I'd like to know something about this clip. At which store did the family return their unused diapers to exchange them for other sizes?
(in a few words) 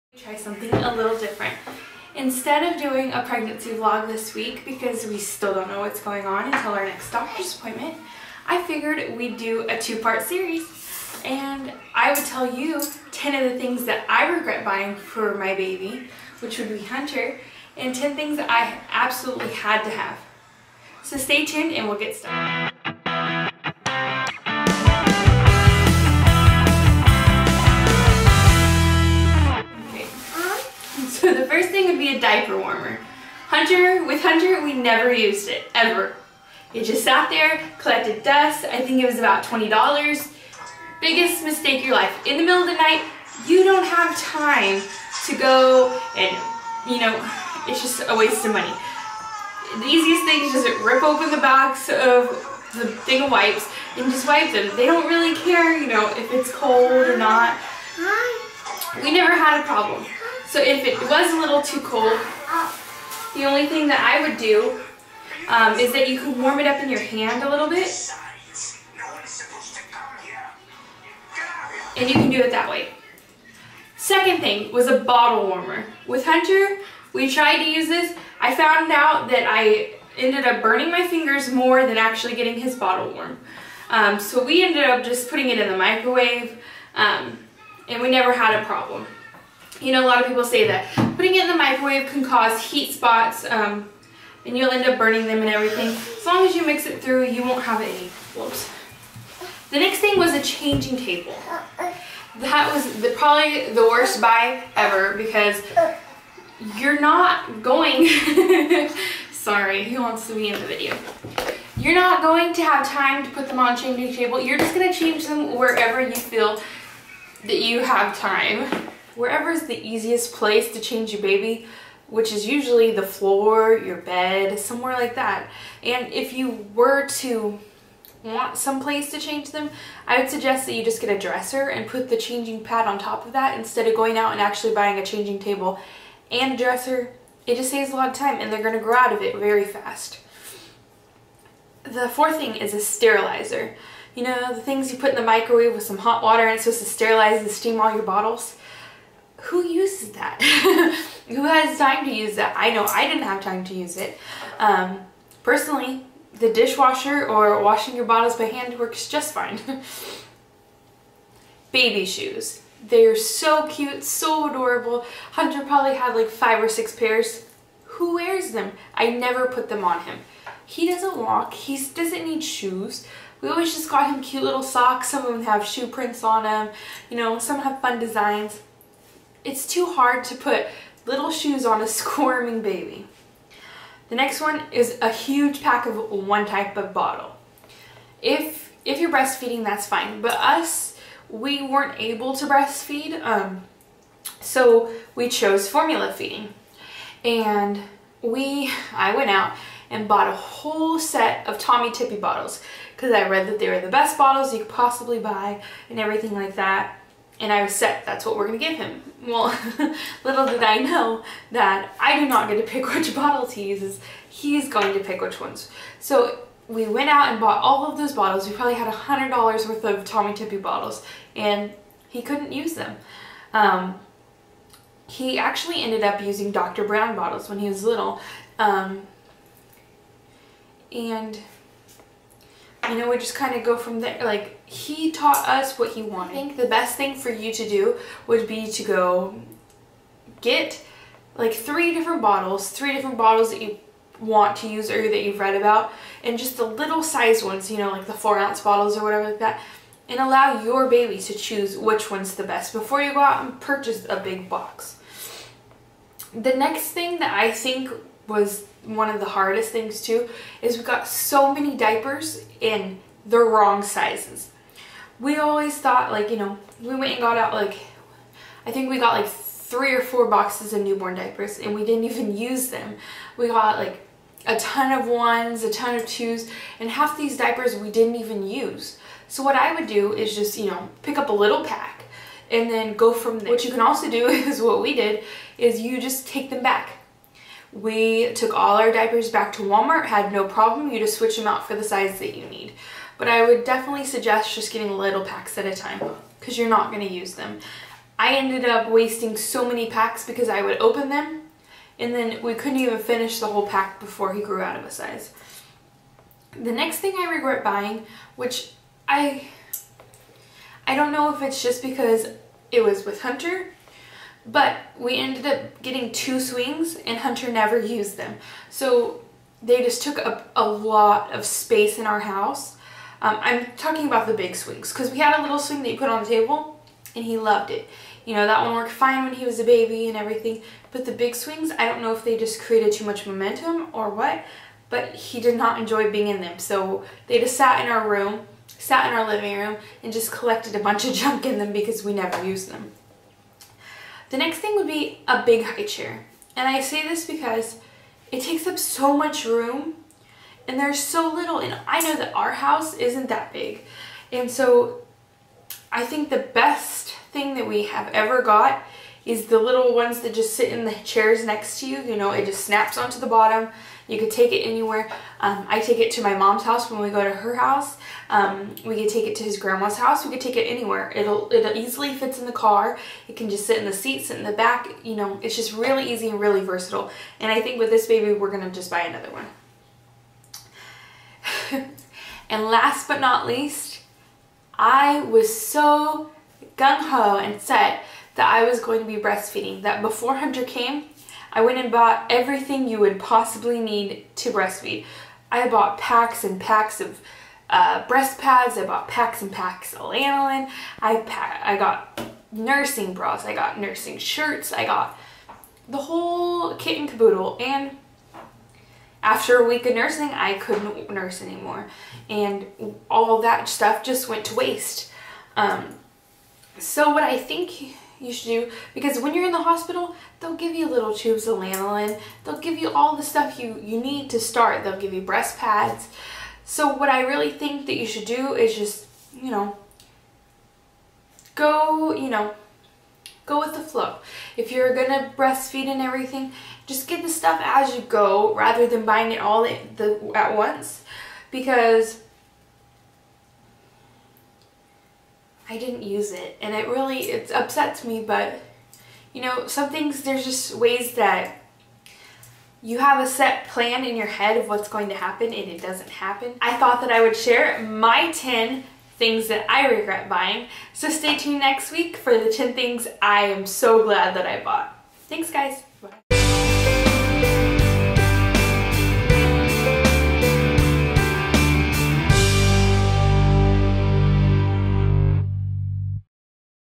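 Walmart.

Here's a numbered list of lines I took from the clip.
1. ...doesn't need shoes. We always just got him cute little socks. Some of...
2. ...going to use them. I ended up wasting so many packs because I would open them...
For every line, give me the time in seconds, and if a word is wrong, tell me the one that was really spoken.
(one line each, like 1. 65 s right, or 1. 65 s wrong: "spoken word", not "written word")
1. 171 s right
2. 296 s right.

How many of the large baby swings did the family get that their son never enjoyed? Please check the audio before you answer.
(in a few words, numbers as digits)
2.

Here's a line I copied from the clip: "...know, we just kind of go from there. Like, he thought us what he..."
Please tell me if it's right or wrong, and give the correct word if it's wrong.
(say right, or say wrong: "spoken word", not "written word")
wrong: "taught", not "thought".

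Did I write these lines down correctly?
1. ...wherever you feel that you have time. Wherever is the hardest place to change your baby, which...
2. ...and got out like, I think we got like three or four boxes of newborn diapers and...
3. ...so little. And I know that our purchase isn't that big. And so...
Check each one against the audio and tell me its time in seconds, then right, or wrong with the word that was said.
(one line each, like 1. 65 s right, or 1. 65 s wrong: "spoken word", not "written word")
1. 115 s wrong: "easiest", not "hardest"
2. 267 s right
3. 350 s wrong: "house", not "purchase".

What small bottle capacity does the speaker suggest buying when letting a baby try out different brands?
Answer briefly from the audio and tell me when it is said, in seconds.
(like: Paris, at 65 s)
4 ounce, at 248 s.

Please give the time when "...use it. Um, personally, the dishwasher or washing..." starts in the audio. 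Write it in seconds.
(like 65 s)
153 s.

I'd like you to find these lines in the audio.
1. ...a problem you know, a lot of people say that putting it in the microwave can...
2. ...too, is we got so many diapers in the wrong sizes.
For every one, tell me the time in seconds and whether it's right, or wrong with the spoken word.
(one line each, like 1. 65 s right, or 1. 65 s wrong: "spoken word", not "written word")
1. 88 s right
2. 260 s right.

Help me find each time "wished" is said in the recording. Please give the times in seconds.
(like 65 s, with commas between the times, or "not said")
not said.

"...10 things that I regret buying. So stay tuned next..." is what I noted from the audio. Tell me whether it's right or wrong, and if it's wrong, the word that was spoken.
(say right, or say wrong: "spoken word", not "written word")
right.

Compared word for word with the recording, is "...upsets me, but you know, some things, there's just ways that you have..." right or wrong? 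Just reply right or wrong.
right.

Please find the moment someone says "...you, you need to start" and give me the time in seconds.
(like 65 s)
423 s.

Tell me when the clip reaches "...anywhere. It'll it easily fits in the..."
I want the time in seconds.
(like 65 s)
370 s.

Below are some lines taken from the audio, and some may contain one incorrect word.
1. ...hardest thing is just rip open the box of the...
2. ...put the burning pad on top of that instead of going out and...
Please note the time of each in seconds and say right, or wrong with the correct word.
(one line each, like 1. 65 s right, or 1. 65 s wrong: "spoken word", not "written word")
1. 49 s wrong: "easiest", not "hardest"
2. 131 s wrong: "changing", not "burning".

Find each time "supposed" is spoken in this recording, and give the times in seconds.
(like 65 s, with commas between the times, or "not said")
146 s.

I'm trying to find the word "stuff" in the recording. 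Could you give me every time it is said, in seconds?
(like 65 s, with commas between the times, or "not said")
413 s, 423 s, 437 s.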